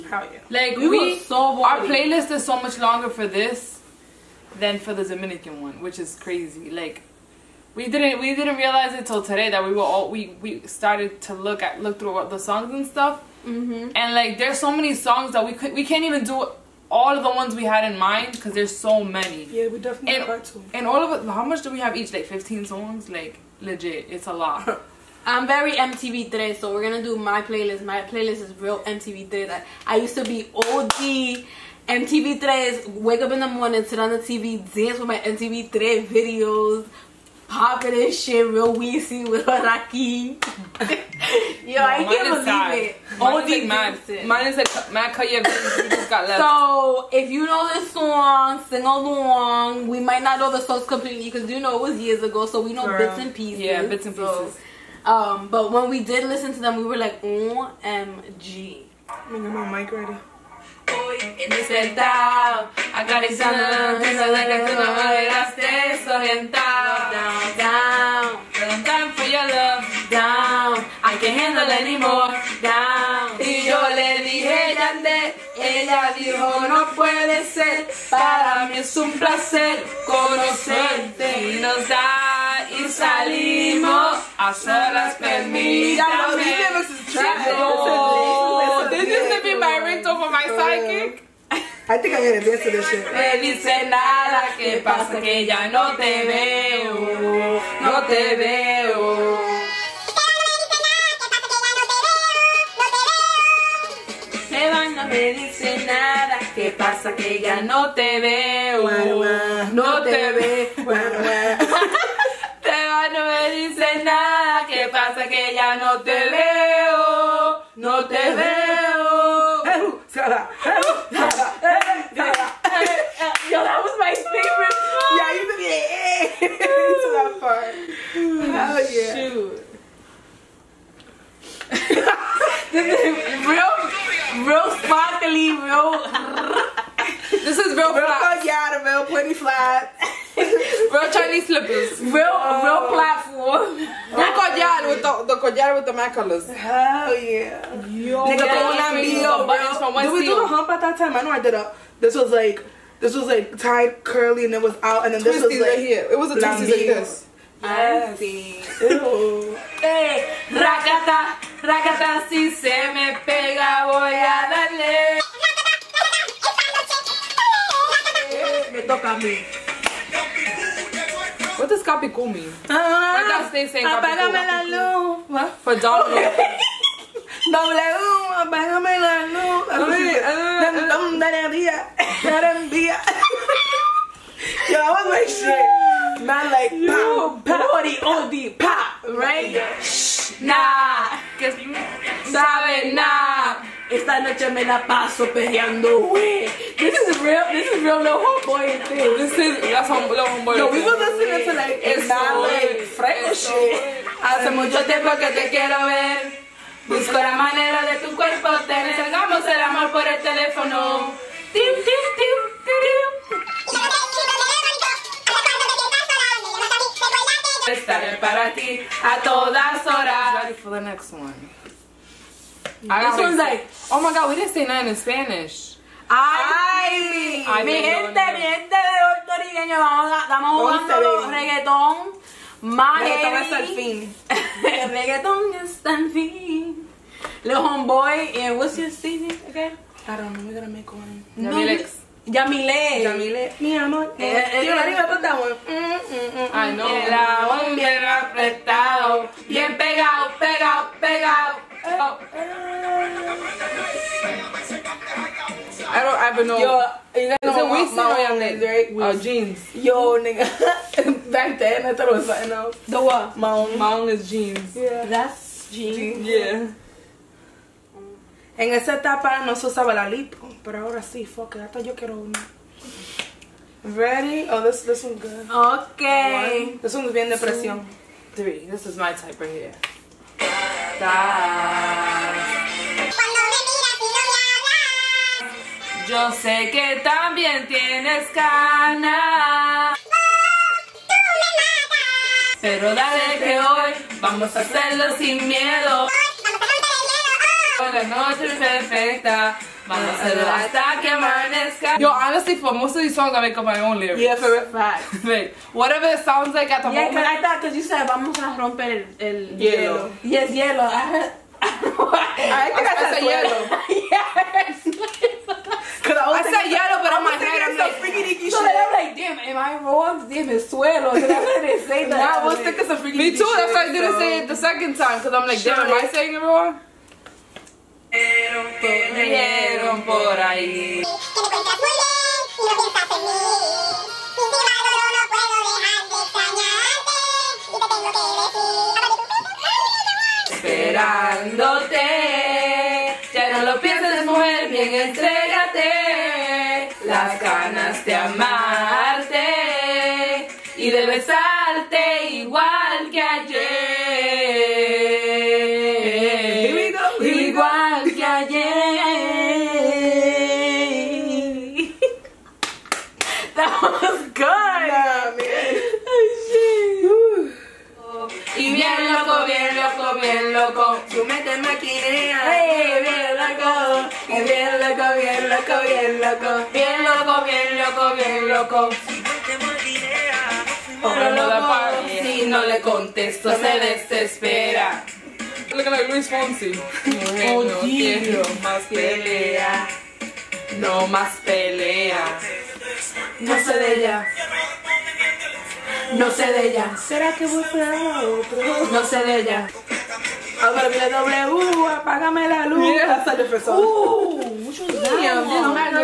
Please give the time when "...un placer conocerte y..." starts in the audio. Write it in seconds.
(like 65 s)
78 s.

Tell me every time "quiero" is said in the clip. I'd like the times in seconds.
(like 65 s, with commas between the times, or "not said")
205 s, 271 s.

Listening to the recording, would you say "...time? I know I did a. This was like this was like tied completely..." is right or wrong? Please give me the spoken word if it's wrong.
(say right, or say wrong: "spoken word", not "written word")
wrong: "curly", not "completely".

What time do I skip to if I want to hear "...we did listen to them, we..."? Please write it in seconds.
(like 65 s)
55 s.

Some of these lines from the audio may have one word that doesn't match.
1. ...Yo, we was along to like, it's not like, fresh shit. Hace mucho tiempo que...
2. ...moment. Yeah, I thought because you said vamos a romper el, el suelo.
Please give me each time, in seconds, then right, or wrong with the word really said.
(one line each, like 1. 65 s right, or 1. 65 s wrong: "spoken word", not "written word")
1. 200 s wrong: "listening", not "along"
2. 306 s wrong: "hielo", not "suelo".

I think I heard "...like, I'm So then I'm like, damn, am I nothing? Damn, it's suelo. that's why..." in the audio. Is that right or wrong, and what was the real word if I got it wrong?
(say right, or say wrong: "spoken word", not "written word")
wrong: "wrong", not "nothing".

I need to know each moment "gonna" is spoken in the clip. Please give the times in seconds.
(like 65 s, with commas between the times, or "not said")
26 s, 240 s.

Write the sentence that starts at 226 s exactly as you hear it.
Ay, Ay mi gente, mi gente de puertorriqueño, vamos, a, estamos jugando reggaetón.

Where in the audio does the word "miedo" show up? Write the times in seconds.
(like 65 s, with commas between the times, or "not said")
295 s.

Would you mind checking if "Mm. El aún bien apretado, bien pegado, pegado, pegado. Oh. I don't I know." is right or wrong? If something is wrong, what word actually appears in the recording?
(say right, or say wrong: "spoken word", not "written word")
right.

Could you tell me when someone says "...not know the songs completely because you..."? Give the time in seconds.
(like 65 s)
50 s.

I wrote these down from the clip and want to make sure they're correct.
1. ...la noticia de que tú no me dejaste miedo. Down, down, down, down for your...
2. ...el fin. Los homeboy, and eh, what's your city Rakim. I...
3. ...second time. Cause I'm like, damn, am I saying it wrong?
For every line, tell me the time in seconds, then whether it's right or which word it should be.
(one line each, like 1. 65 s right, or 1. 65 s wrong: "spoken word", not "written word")
1. 63 s wrong: "desorientado", not "miedo"
2. 235 s wrong: "Okay", not "Rakim"
3. 324 s right.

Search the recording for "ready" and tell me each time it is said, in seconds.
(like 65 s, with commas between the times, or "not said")
59 s, 220 s, 273 s.